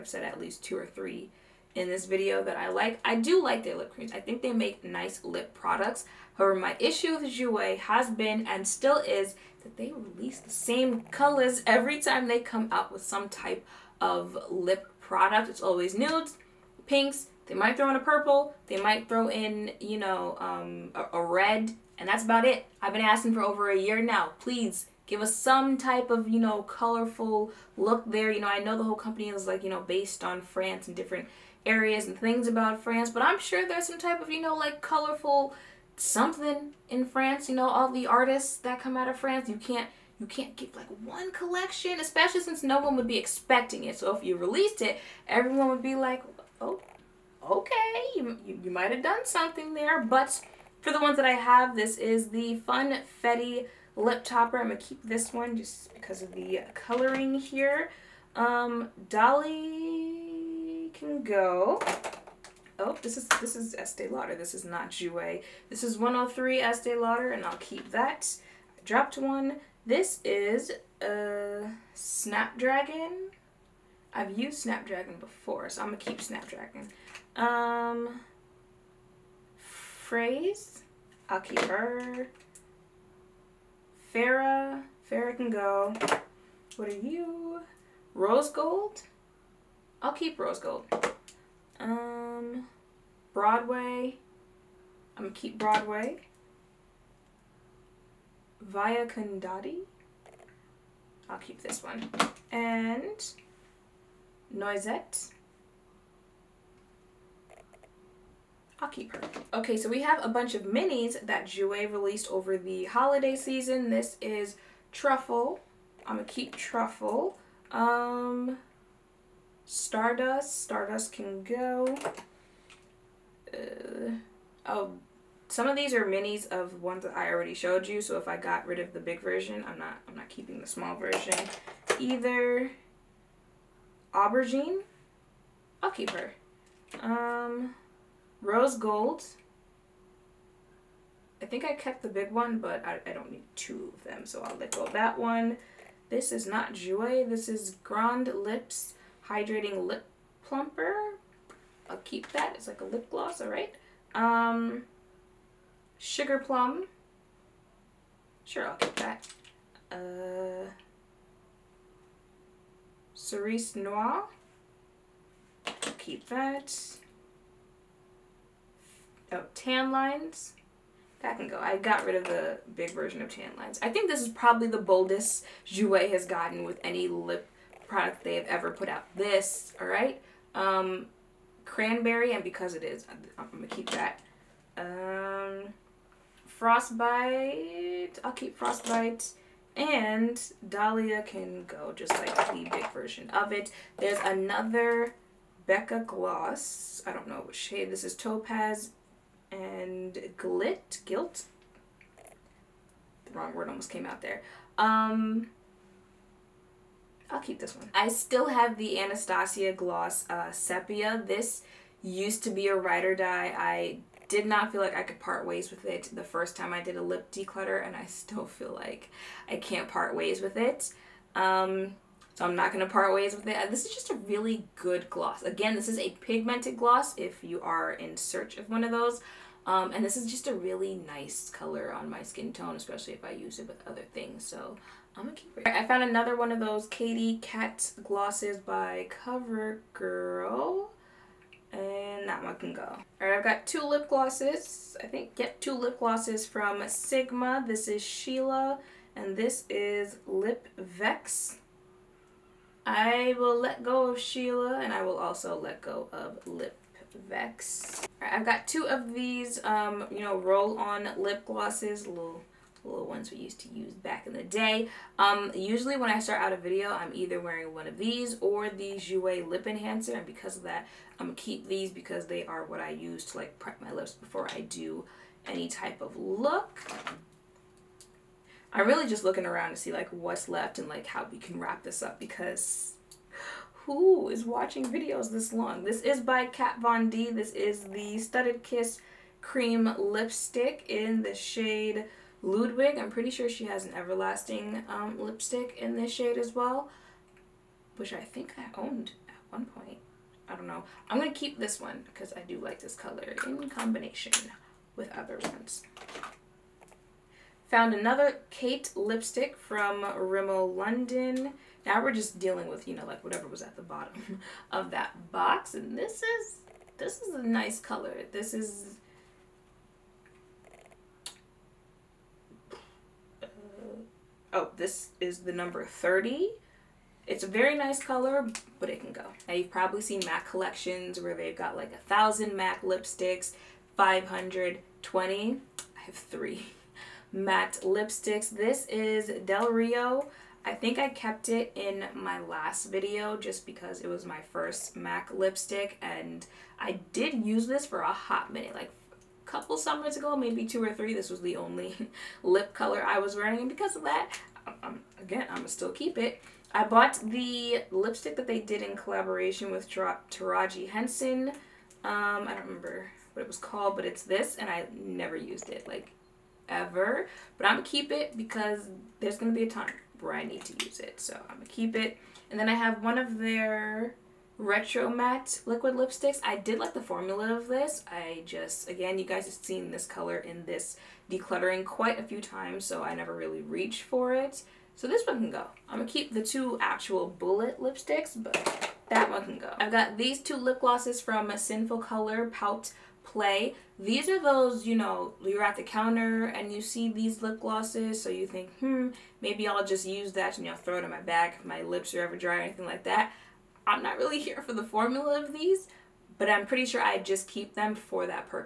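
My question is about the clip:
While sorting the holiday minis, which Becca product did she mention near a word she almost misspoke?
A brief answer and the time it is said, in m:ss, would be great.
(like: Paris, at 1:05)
Topaz, at 3:18.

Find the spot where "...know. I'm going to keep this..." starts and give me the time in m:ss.
5:00.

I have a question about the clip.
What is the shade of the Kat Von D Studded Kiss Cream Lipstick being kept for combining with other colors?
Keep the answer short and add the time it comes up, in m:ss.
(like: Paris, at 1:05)
Ludwig, at 4:52.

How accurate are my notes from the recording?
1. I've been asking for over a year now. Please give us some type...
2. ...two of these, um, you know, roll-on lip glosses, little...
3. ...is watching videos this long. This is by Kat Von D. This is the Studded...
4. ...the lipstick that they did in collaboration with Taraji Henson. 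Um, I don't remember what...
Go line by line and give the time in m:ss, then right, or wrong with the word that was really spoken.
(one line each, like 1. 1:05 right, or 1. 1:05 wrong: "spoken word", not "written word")
1. 0:22 right
2. 4:18 right
3. 4:44 right
4. 5:57 right.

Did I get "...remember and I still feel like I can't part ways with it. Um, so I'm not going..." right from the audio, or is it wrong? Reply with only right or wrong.
wrong.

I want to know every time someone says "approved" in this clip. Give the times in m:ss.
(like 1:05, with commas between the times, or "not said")
not said.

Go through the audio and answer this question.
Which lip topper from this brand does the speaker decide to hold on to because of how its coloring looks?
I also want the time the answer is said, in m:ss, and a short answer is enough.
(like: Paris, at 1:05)
Funfetti, at 0:52.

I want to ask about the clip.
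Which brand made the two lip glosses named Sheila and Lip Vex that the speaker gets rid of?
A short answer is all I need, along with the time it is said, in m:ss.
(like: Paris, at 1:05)
Sigma, at 4:06.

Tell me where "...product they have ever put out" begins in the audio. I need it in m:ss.
2:57.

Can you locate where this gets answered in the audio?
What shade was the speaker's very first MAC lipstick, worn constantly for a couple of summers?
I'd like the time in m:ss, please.
5:39.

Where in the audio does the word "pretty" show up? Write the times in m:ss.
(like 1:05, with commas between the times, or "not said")
4:53, 6:46.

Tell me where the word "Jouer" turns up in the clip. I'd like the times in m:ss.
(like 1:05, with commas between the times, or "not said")
0:07, 1:04, 1:51, 2:55, 4:28.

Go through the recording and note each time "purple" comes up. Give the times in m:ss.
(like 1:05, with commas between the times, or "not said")
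0:17.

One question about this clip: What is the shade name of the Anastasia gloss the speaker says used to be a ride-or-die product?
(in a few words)
Sepia.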